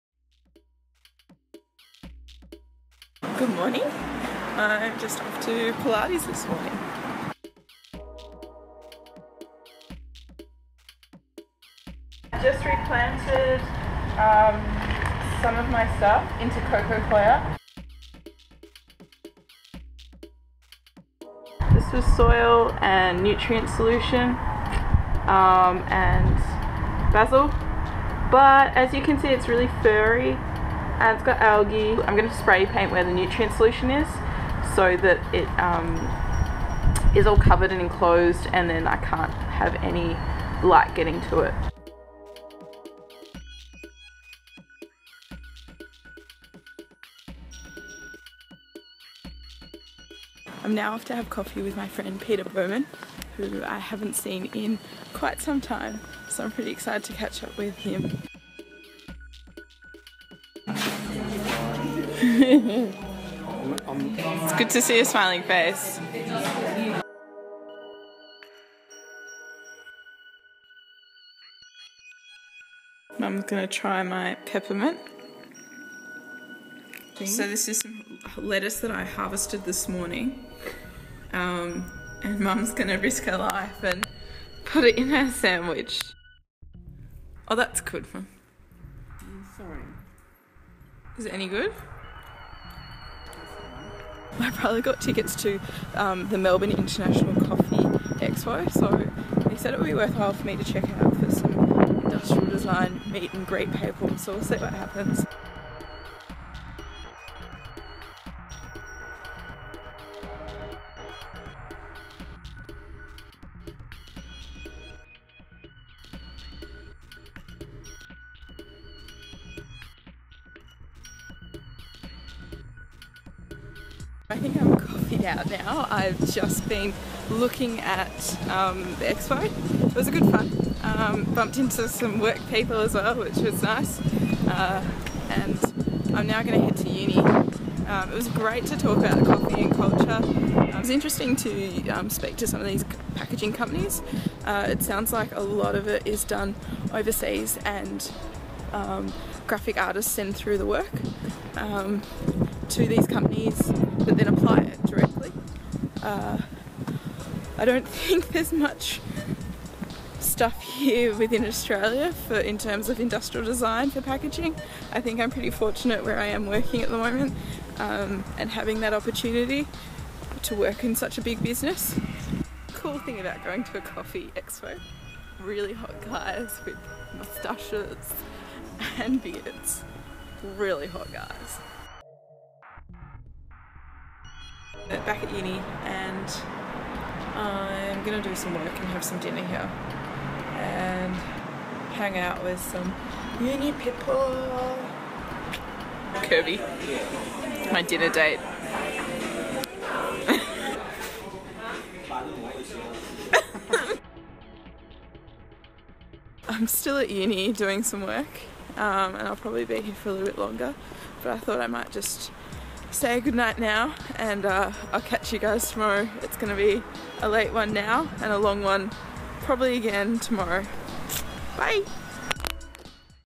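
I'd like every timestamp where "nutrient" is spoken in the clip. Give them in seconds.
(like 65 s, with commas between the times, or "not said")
23 s, 33 s.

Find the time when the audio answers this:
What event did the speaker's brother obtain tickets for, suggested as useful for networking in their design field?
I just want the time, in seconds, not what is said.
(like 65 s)
96 s.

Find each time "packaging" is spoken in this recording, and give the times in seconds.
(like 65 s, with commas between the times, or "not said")
143 s, 164 s.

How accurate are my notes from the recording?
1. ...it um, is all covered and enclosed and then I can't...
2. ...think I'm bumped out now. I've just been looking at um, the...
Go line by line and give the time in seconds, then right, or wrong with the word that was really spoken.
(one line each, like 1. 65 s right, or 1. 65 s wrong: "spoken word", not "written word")
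1. 35 s right
2. 124 s wrong: "coffeeed", not "bumped".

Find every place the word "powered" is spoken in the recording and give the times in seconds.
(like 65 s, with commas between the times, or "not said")
not said.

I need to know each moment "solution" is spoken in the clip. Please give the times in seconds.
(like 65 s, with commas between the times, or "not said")
23 s, 33 s.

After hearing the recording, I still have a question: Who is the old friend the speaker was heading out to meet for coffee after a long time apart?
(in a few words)
Peter Bowman.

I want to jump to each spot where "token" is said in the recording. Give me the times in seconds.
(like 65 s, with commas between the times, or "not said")
not said.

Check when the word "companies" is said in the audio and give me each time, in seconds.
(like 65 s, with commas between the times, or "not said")
143 s, 153 s.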